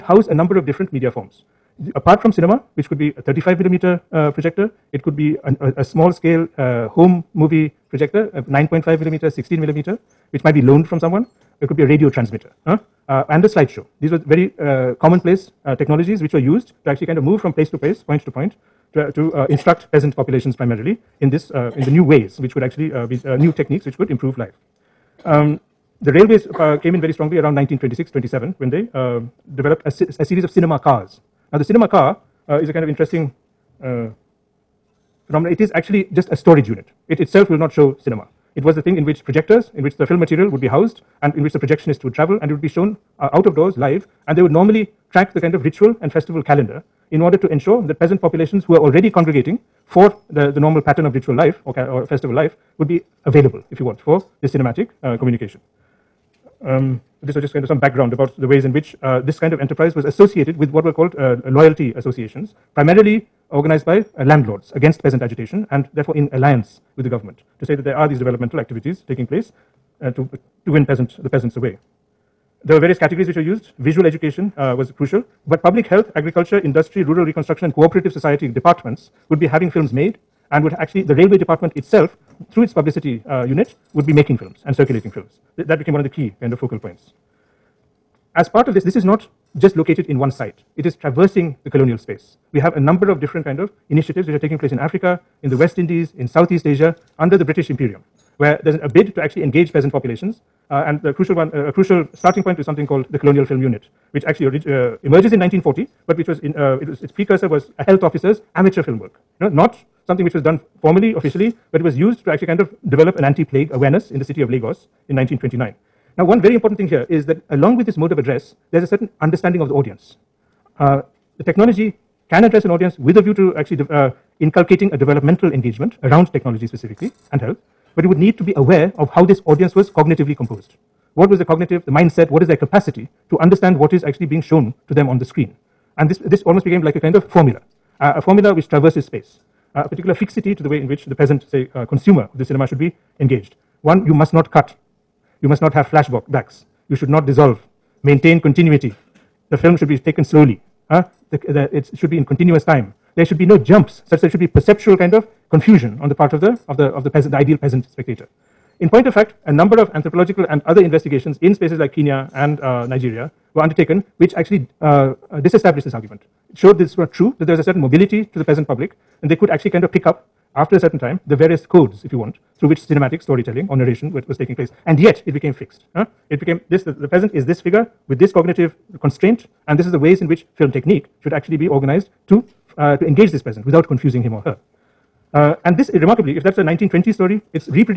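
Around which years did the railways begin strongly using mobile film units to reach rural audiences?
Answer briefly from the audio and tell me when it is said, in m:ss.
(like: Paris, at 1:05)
1926-27, at 0:27.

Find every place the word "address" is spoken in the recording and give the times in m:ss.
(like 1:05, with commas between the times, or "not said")
1:58, 2:02.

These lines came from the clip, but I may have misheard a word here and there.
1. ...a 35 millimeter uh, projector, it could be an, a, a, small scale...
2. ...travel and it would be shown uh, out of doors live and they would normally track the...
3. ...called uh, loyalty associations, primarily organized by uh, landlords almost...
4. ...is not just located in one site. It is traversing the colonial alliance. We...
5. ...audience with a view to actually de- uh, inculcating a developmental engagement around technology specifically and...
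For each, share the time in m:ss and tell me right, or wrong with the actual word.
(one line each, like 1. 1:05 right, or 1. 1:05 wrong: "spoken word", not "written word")
1. 0:03 right
2. 0:42 right
3. 1:00 wrong: "against", not "almost"
4. 1:28 wrong: "space", not "alliance"
5. 2:02 right.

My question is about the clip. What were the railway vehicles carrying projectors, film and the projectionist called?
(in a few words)
cinema cars.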